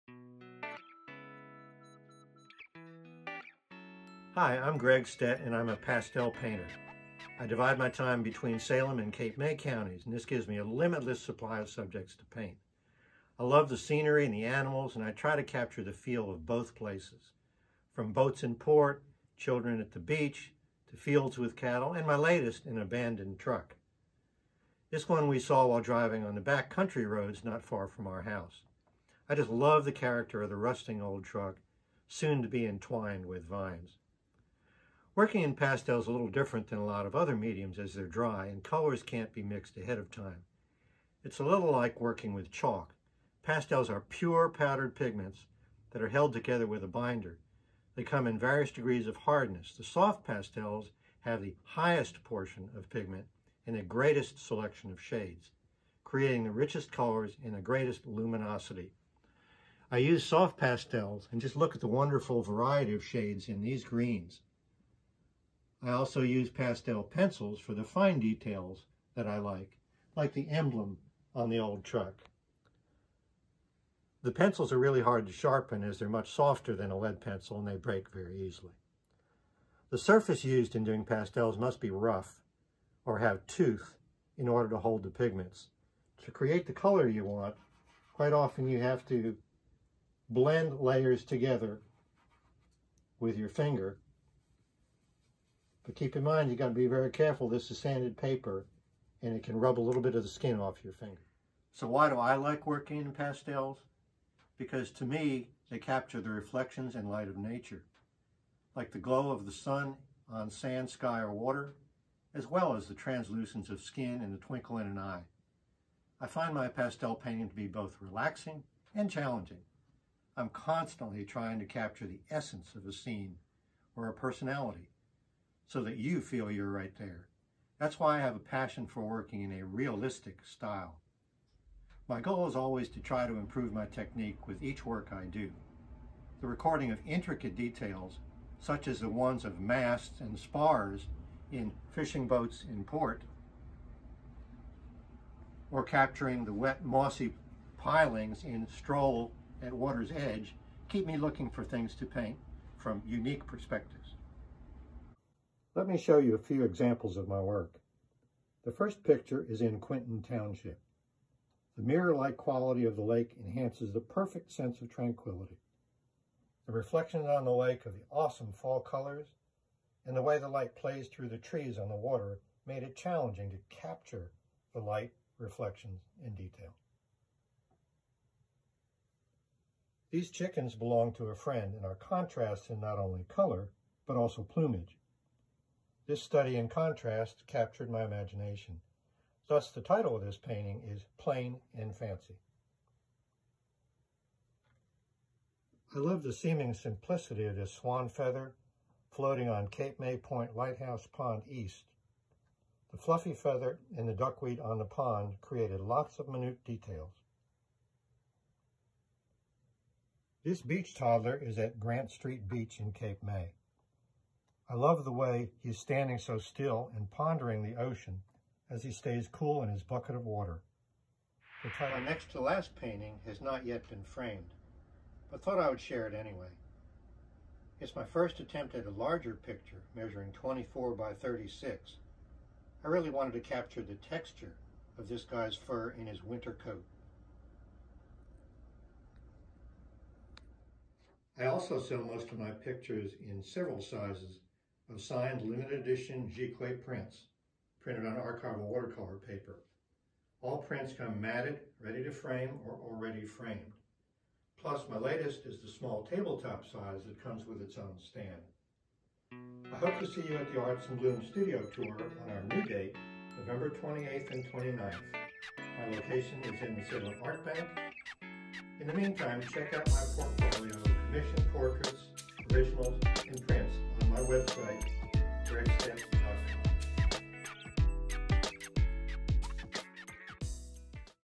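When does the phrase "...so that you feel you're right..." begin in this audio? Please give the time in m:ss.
2:05.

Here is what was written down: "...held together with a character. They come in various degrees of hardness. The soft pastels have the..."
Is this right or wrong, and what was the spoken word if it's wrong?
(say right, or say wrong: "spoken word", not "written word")
wrong: "binder", not "character".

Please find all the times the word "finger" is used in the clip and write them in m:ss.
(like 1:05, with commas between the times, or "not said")
1:33, 1:40.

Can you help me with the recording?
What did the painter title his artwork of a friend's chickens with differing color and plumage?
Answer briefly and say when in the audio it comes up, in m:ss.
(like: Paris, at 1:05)
Plain and Fancy, at 3:11.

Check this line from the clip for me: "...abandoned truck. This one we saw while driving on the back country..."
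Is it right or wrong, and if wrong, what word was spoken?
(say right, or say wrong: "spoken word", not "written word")
right.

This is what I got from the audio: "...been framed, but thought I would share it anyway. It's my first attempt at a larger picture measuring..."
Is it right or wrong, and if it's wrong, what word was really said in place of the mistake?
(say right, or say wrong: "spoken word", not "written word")
right.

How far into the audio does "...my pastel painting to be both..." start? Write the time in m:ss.
1:56.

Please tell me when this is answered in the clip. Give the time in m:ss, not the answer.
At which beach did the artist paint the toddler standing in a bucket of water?
3:31.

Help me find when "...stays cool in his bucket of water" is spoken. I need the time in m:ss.
3:38.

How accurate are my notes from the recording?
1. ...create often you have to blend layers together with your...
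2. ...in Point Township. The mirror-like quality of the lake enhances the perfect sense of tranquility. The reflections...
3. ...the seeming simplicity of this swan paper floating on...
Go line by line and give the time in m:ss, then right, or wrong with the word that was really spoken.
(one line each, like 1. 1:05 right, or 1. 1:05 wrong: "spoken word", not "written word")
1. 1:28 wrong: "quite", not "create"
2. 2:39 wrong: "Quinton", not "Point"
3. 3:16 wrong: "feather", not "paper".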